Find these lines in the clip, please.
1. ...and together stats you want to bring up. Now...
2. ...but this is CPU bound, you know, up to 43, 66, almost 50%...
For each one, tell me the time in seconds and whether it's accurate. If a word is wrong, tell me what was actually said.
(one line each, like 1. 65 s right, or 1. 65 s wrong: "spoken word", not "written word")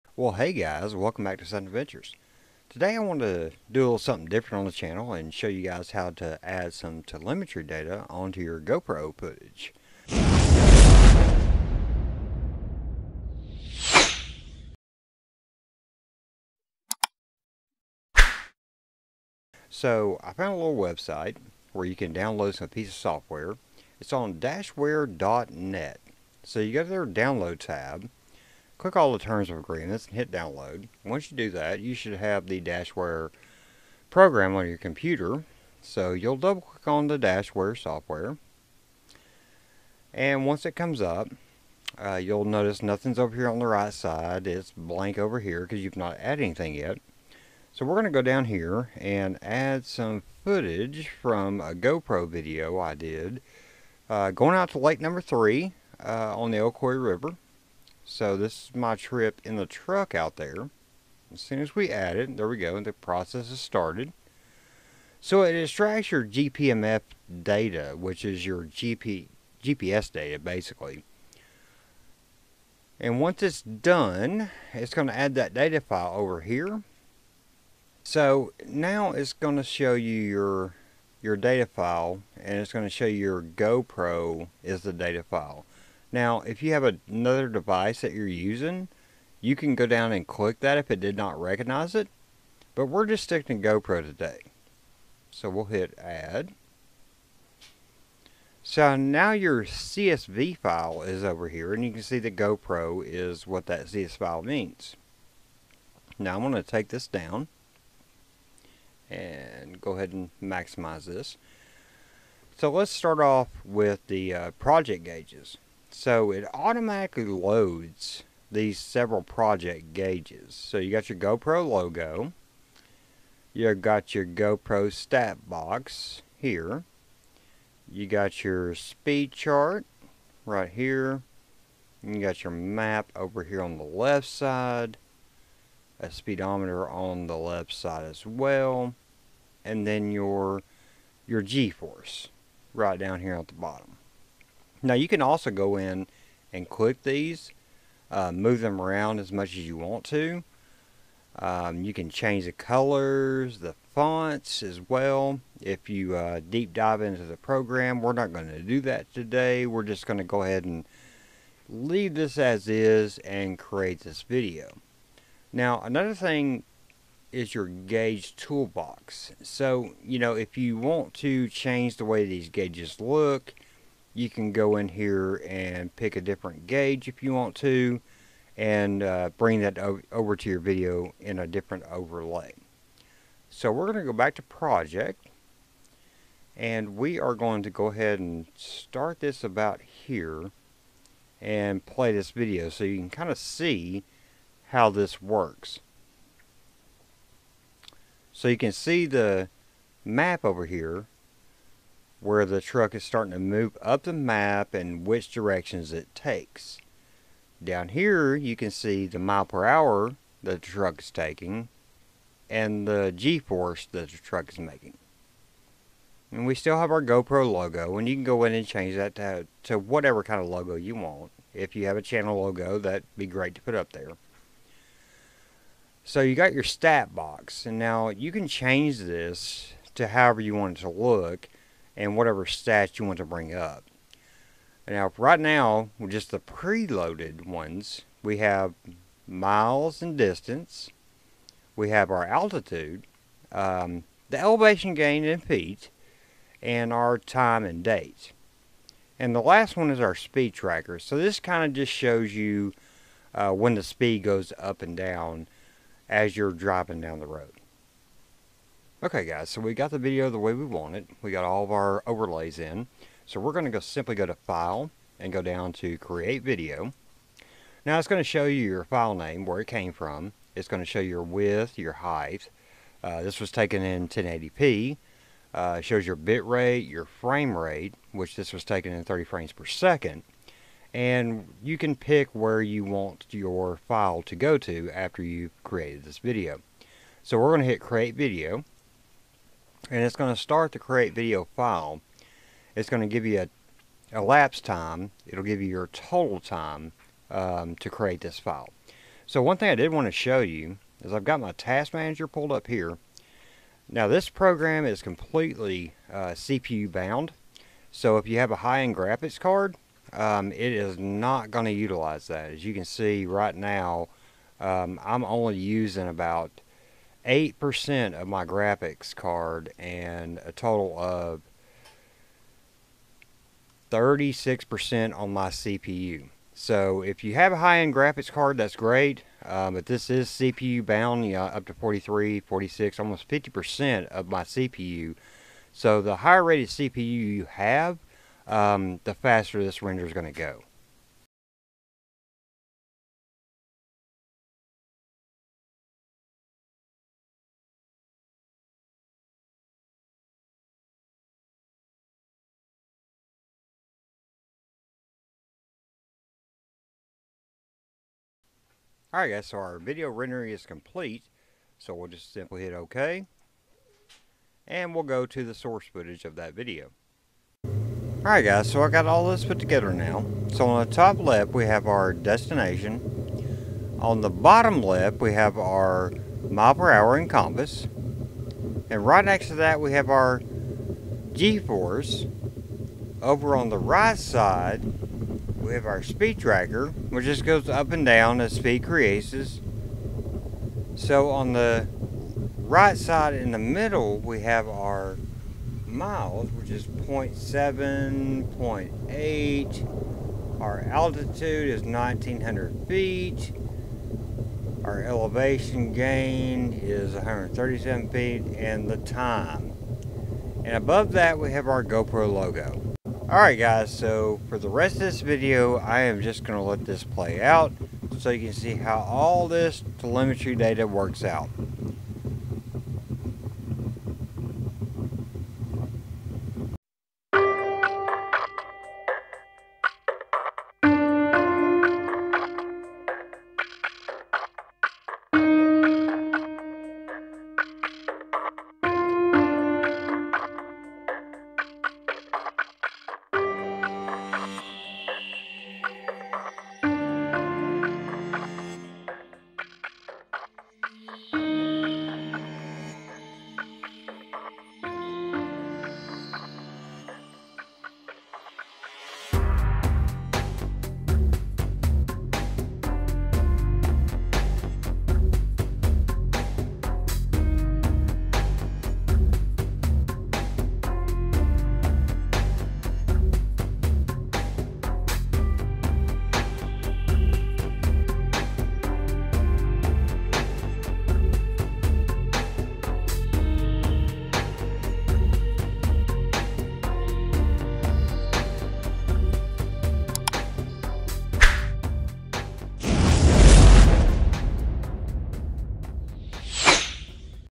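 1. 231 s wrong: "whatever", not "together"
2. 329 s wrong: "46", not "66".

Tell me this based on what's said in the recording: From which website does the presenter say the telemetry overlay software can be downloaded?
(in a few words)
dashware.net.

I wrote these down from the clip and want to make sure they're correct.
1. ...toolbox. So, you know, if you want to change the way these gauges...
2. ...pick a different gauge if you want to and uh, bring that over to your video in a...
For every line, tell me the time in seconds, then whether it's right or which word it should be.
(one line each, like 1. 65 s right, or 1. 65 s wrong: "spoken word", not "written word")
1. 168 s right
2. 175 s right.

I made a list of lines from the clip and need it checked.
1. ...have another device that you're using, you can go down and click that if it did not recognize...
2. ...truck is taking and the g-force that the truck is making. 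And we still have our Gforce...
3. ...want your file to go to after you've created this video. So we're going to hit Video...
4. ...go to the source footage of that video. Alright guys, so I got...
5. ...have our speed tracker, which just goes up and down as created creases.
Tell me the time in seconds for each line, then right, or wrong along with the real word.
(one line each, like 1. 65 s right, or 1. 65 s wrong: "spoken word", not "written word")
1. 86 s right
2. 210 s wrong: "GoPro", not "Gforce"
3. 282 s wrong: "Create", not "Video"
4. 365 s right
5. 385 s wrong: "speed", not "created".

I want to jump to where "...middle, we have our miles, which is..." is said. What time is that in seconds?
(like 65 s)
393 s.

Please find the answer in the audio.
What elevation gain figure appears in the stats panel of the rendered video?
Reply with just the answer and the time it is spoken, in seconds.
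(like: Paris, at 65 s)
137 feet, at 407 s.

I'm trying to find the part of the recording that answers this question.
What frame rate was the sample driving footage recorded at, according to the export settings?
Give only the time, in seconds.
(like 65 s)
279 s.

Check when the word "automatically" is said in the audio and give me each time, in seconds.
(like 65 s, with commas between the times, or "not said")
116 s.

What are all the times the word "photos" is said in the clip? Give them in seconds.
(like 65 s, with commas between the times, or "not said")
not said.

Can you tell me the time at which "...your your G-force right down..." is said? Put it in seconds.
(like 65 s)
140 s.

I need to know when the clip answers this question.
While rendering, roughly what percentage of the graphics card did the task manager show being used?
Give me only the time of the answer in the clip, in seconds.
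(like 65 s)
317 s.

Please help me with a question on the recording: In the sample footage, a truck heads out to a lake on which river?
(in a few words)
Ocoee River.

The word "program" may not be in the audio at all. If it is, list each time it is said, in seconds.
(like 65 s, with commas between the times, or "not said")
34 s, 157 s, 304 s.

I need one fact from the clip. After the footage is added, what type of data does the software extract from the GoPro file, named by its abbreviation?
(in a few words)
GPMF.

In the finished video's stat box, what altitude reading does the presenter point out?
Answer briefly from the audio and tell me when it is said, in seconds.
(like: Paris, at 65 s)
1900 feet, at 401 s.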